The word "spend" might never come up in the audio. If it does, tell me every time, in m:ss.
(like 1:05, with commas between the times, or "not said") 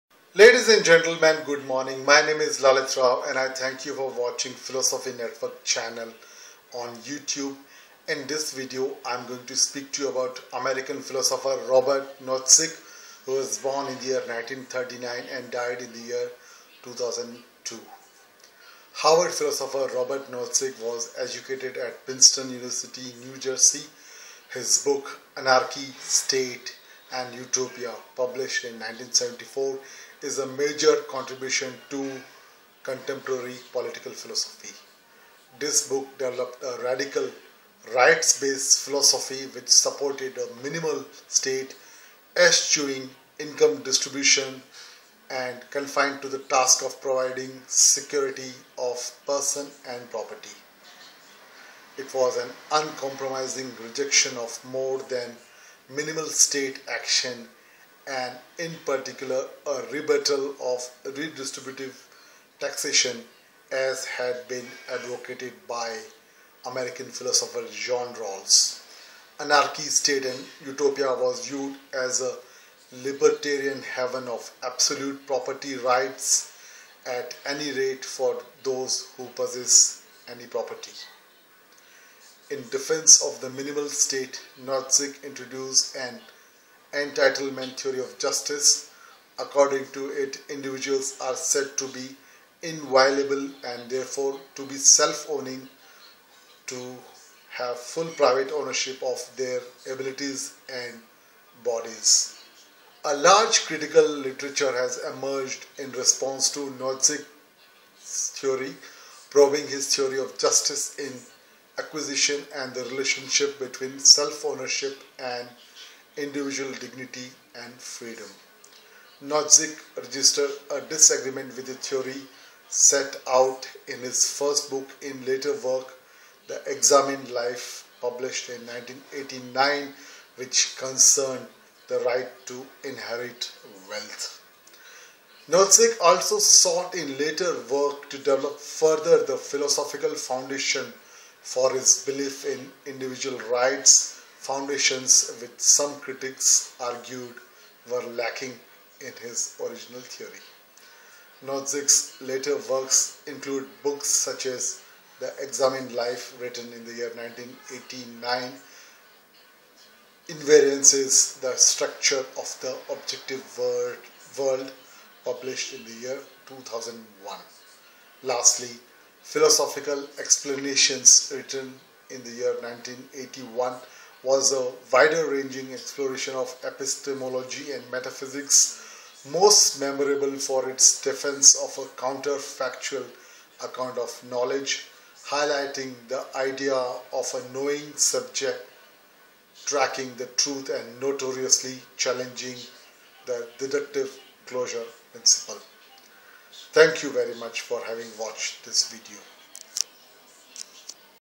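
not said.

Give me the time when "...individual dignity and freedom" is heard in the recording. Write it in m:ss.
1:56.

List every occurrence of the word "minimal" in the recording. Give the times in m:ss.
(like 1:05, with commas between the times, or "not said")
0:40, 0:55, 1:23.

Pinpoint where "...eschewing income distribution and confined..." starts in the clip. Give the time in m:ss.
0:42.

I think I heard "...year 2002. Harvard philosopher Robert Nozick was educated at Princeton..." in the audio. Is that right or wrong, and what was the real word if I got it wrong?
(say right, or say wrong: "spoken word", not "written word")
right.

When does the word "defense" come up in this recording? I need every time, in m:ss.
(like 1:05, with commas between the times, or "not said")
1:22, 3:01.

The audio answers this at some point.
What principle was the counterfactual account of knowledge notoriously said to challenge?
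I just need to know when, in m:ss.
3:13.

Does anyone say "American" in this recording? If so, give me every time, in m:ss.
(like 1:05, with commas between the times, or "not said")
0:10, 1:06.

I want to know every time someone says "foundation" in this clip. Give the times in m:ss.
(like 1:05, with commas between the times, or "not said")
2:20, 2:24.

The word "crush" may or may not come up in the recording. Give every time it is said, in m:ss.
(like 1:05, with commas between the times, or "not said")
not said.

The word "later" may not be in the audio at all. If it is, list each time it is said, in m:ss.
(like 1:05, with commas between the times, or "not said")
2:05, 2:17, 2:32.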